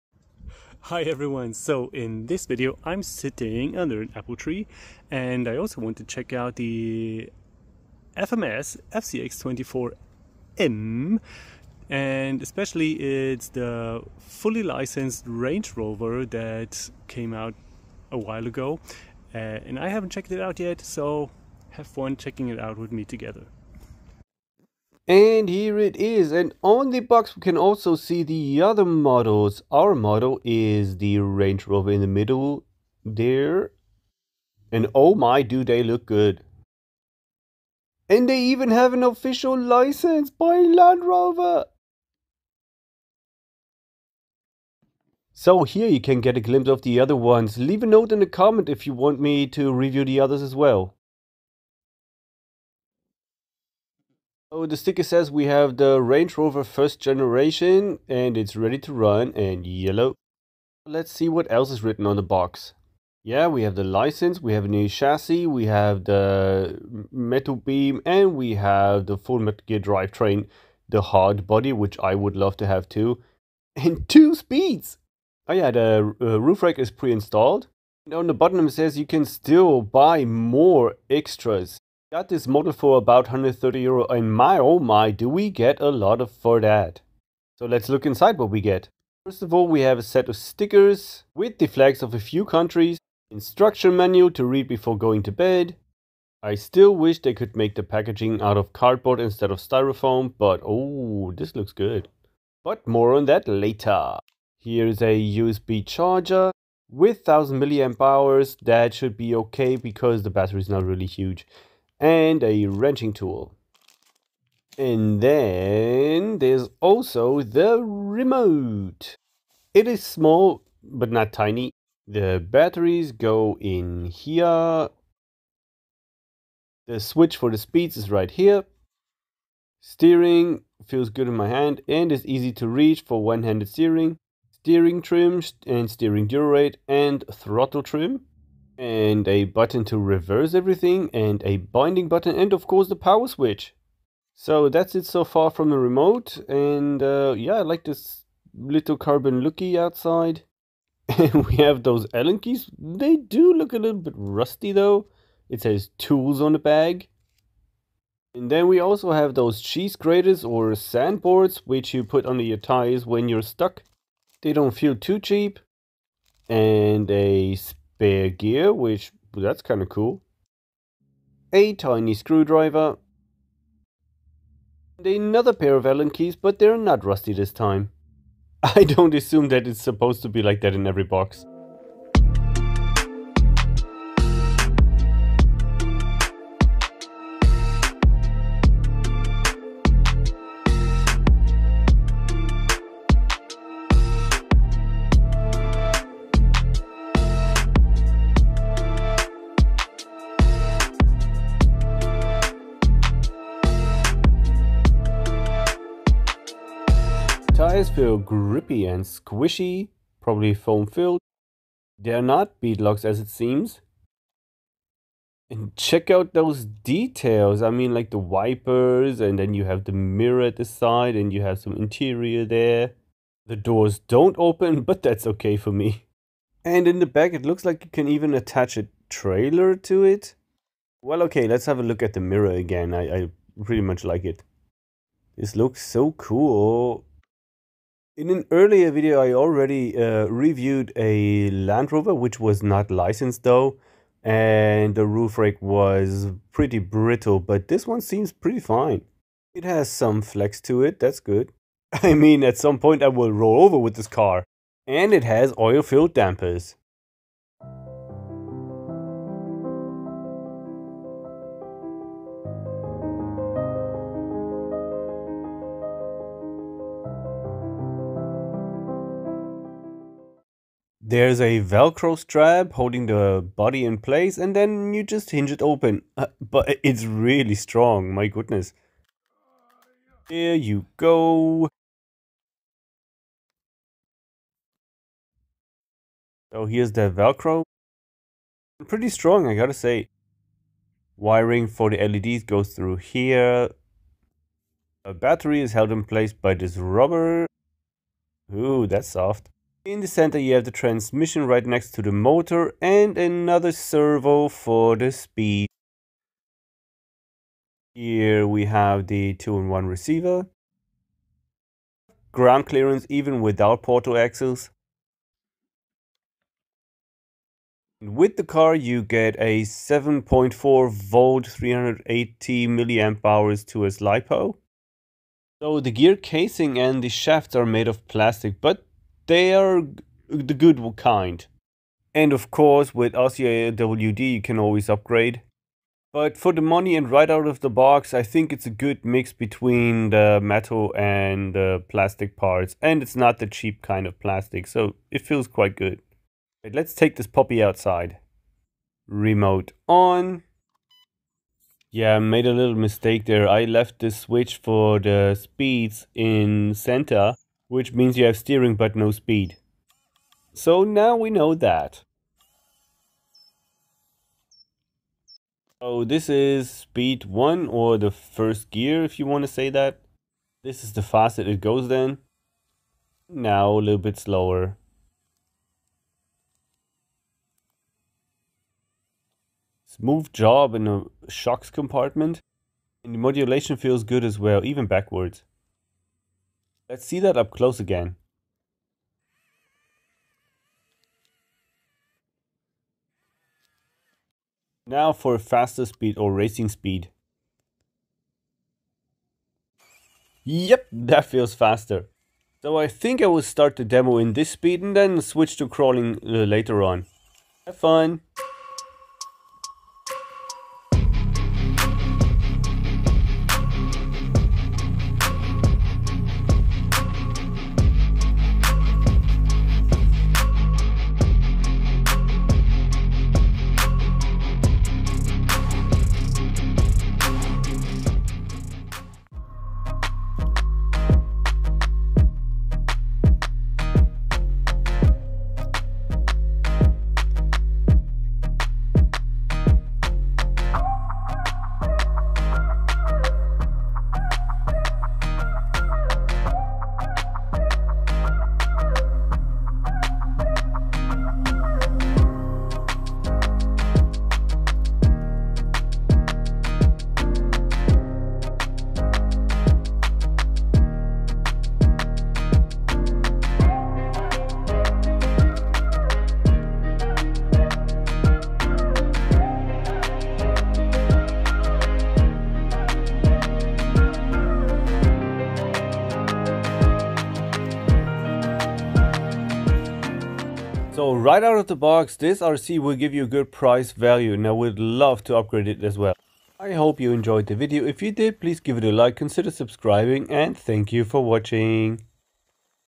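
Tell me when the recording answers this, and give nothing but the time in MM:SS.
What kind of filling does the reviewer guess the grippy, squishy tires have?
03:30.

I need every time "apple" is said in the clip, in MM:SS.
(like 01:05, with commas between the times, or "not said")
00:04.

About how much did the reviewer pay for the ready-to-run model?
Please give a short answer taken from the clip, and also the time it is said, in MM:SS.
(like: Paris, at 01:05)
130 euro, at 01:23.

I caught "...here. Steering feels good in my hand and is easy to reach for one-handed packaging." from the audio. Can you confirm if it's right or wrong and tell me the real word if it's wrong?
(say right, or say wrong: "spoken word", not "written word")
wrong: "steering", not "packaging".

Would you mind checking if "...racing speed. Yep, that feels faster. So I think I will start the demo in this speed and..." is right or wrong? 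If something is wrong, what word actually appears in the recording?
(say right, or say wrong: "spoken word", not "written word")
right.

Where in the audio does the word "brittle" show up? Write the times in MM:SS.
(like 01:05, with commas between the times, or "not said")
04:06.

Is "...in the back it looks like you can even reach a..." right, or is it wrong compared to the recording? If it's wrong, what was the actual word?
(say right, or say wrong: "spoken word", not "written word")
wrong: "attach", not "reach".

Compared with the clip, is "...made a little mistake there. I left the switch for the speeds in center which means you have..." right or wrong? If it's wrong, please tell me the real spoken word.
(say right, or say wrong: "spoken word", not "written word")
right.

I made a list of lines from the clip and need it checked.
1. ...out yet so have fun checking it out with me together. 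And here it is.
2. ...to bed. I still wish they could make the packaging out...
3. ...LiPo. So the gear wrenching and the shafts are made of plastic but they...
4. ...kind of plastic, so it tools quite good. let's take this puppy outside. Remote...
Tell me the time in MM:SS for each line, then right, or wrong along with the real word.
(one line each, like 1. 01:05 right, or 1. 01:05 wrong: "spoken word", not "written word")
1. 00:20 right
2. 01:35 right
3. 05:23 wrong: "casing", not "wrenching"
4. 05:43 wrong: "feels", not "tools".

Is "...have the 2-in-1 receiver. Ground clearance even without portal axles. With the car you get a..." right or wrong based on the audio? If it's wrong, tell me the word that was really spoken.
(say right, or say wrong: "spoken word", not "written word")
right.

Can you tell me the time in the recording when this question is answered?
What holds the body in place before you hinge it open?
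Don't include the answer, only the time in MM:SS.
04:31.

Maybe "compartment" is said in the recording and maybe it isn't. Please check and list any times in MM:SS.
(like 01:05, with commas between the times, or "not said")
06:21.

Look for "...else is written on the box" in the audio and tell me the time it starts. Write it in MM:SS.
01:01.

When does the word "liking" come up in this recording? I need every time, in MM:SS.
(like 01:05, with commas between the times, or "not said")
not said.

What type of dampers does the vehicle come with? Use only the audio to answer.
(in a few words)
oil-filled dampers.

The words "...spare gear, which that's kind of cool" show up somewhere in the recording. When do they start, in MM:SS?
02:48.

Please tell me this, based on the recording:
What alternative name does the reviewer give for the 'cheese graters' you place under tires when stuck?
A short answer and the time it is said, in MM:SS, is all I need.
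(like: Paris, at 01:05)
sandboards, at 02:40.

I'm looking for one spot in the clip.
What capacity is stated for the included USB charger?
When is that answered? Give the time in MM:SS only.
01:47.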